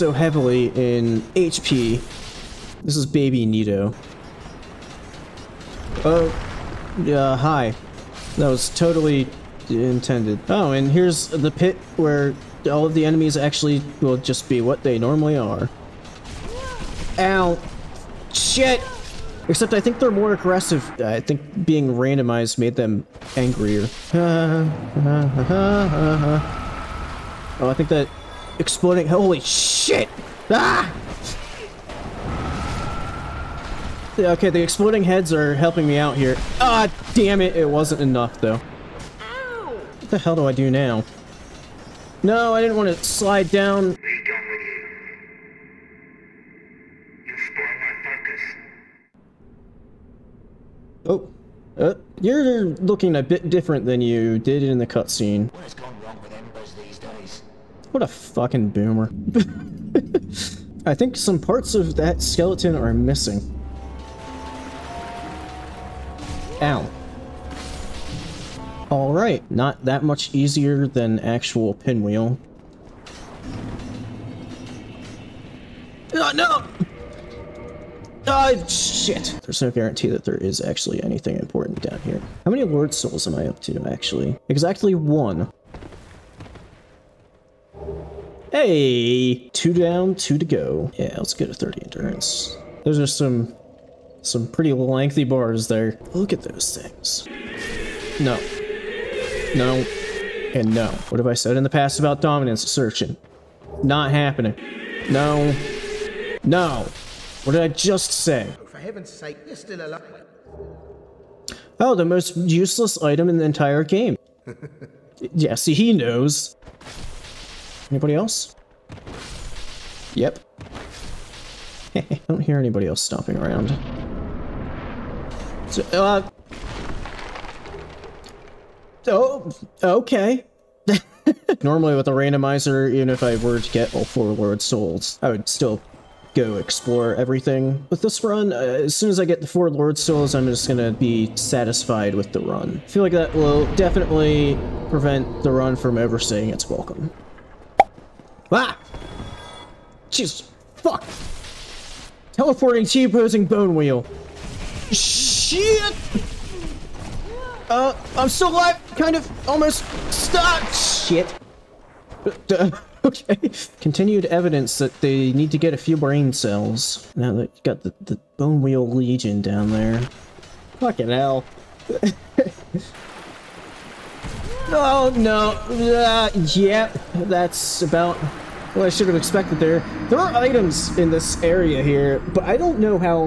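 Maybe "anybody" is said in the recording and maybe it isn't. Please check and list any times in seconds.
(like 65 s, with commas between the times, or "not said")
117 s, 122 s.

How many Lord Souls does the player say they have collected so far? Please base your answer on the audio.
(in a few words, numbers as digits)
1.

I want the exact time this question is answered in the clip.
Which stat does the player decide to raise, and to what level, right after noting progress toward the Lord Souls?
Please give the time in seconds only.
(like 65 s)
91 s.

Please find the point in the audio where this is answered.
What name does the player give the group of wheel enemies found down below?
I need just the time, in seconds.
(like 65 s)
168 s.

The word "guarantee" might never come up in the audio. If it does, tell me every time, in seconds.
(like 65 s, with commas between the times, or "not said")
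79 s.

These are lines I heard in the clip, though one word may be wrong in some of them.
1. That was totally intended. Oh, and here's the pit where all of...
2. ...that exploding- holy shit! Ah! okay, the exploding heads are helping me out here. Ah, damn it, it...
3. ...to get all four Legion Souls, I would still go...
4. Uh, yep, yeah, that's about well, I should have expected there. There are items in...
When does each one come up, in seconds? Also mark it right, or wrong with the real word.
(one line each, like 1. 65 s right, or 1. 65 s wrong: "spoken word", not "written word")
1. 8 s right
2. 27 s right
3. 133 s wrong: "Lord", not "Legion"
4. 175 s right.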